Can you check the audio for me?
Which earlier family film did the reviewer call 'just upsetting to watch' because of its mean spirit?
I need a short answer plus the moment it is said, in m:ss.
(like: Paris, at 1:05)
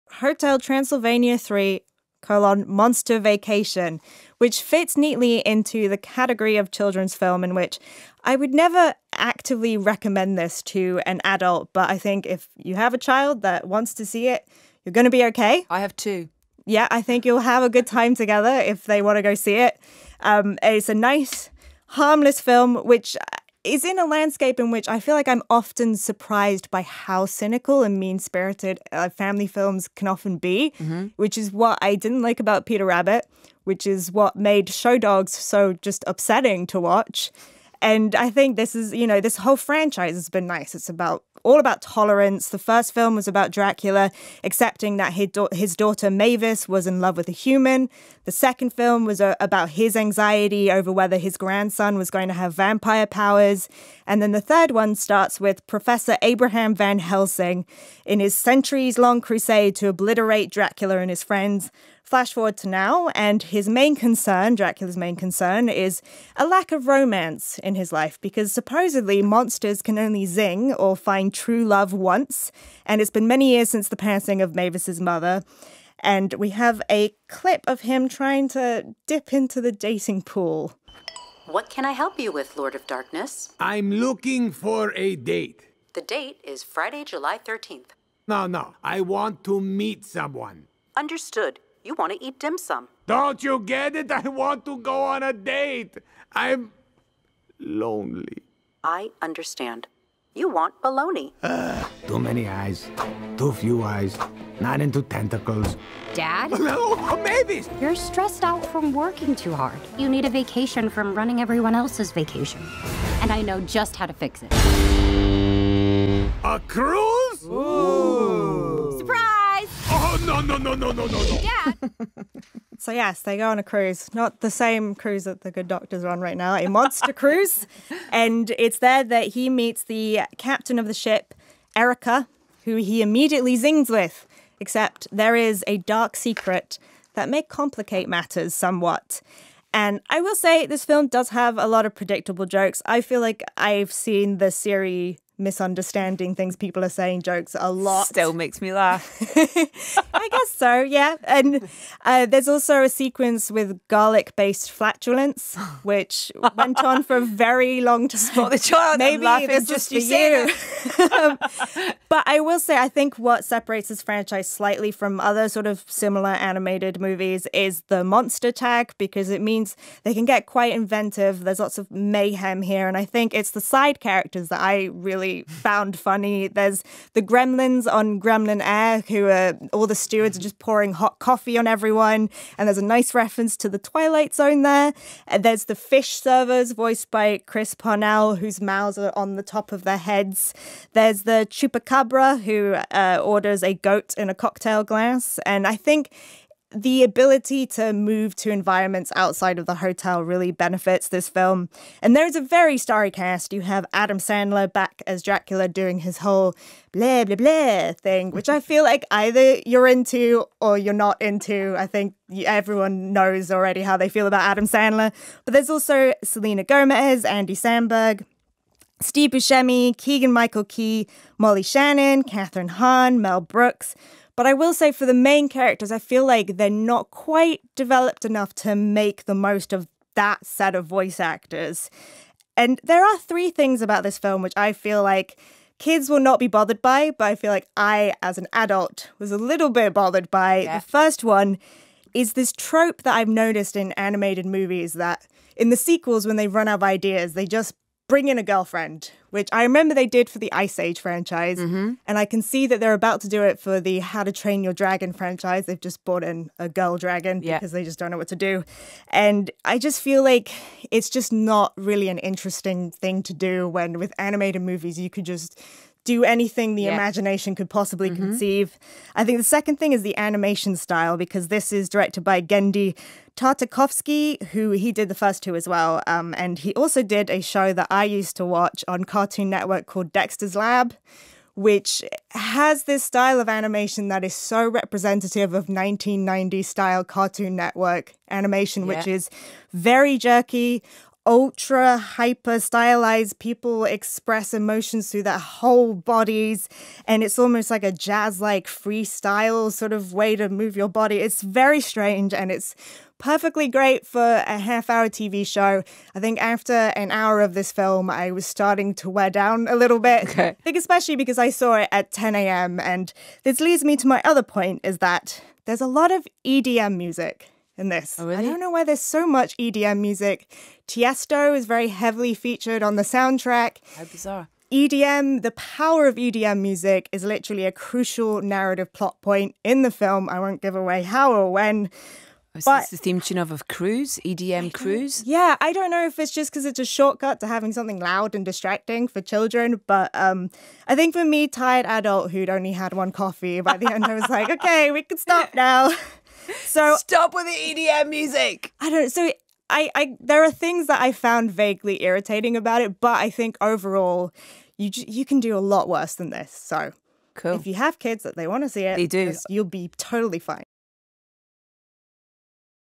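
Show Dogs, at 0:34.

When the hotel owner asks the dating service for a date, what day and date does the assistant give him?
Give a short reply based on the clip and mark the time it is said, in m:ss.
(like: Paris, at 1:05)
Friday, July 13th, at 1:26.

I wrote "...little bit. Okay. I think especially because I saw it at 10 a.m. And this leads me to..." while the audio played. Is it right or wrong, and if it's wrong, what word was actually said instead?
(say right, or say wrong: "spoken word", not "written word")
right.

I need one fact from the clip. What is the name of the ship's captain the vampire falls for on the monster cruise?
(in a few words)
Erica.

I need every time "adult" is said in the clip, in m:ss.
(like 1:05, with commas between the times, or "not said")
0:11, 3:58, 5:41.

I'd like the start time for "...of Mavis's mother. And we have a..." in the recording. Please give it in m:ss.
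1:14.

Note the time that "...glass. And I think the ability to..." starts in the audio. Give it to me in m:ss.
3:14.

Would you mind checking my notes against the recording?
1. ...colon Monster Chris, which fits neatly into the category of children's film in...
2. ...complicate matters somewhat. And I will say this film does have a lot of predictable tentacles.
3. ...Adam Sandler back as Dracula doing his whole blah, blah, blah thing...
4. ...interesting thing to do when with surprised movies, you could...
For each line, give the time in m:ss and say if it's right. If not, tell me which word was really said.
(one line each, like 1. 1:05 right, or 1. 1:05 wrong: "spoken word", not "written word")
1. 0:02 wrong: "Vacation", not "Chris"
2. 2:17 wrong: "jokes", not "tentacles"
3. 3:23 right
4. 4:22 wrong: "animated", not "surprised".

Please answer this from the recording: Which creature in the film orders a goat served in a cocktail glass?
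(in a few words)
The chupacabra.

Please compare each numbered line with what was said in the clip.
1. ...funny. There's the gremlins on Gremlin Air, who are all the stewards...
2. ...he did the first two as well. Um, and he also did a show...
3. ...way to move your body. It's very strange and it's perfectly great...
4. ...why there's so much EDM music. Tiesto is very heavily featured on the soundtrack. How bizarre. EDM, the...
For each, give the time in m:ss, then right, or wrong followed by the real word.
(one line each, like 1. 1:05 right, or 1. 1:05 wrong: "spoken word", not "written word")
1. 2:55 right
2. 4:34 right
3. 5:00 right
4. 5:18 right.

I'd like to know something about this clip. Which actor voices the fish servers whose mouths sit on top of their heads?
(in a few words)
Chris Parnell.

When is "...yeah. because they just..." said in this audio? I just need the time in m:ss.
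4:17.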